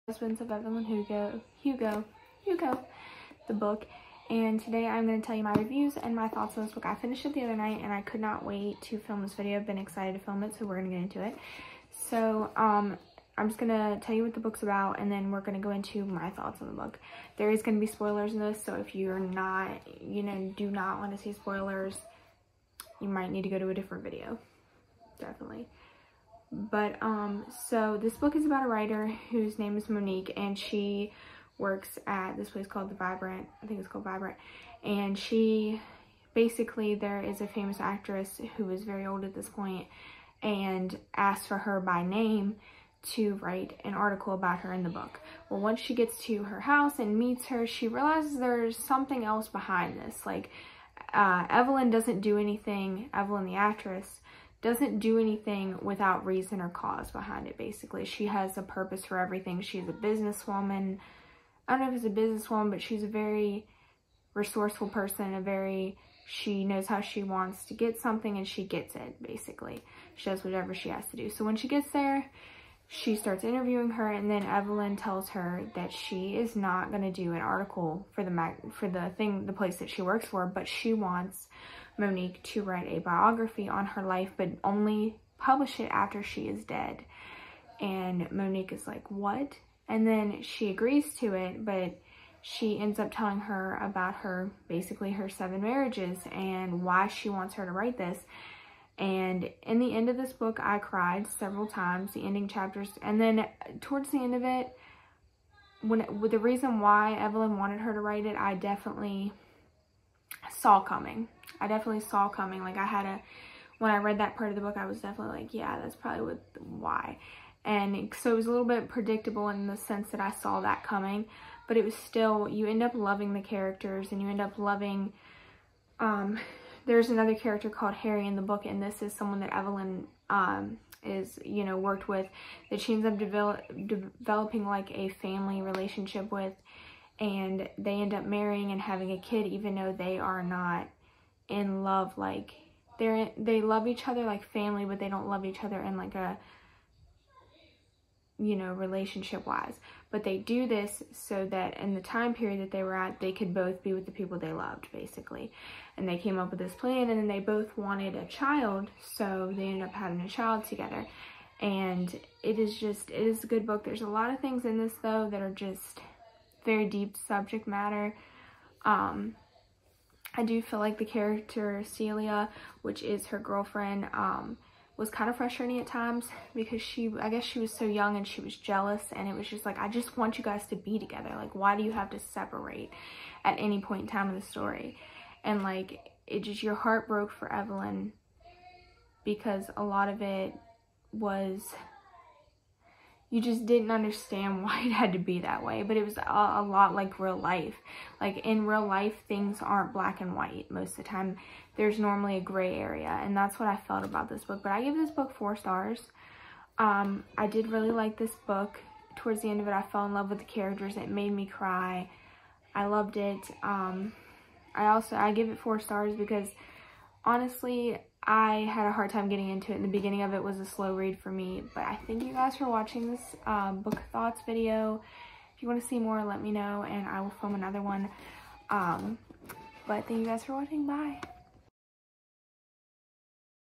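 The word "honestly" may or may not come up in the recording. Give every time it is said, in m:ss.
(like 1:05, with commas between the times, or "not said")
3:37.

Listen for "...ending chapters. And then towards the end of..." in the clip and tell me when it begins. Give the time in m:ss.
1:42.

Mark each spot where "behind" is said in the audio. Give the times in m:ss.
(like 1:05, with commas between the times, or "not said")
0:49, 0:57.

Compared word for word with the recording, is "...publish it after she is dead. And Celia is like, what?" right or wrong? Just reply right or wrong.
wrong.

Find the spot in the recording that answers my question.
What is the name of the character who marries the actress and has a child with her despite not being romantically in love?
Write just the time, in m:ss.
2:07.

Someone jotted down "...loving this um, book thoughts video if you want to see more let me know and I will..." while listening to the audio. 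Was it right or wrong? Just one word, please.
wrong.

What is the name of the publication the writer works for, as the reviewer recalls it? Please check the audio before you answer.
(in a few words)
The Vibrant.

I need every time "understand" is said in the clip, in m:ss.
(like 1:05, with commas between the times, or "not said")
3:13.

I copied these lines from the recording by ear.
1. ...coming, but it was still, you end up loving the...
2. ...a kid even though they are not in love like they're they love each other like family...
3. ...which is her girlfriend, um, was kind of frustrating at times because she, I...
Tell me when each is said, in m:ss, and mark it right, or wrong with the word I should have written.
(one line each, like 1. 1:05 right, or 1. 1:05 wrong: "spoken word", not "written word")
1. 2:00 right
2. 2:19 right
3. 2:52 right.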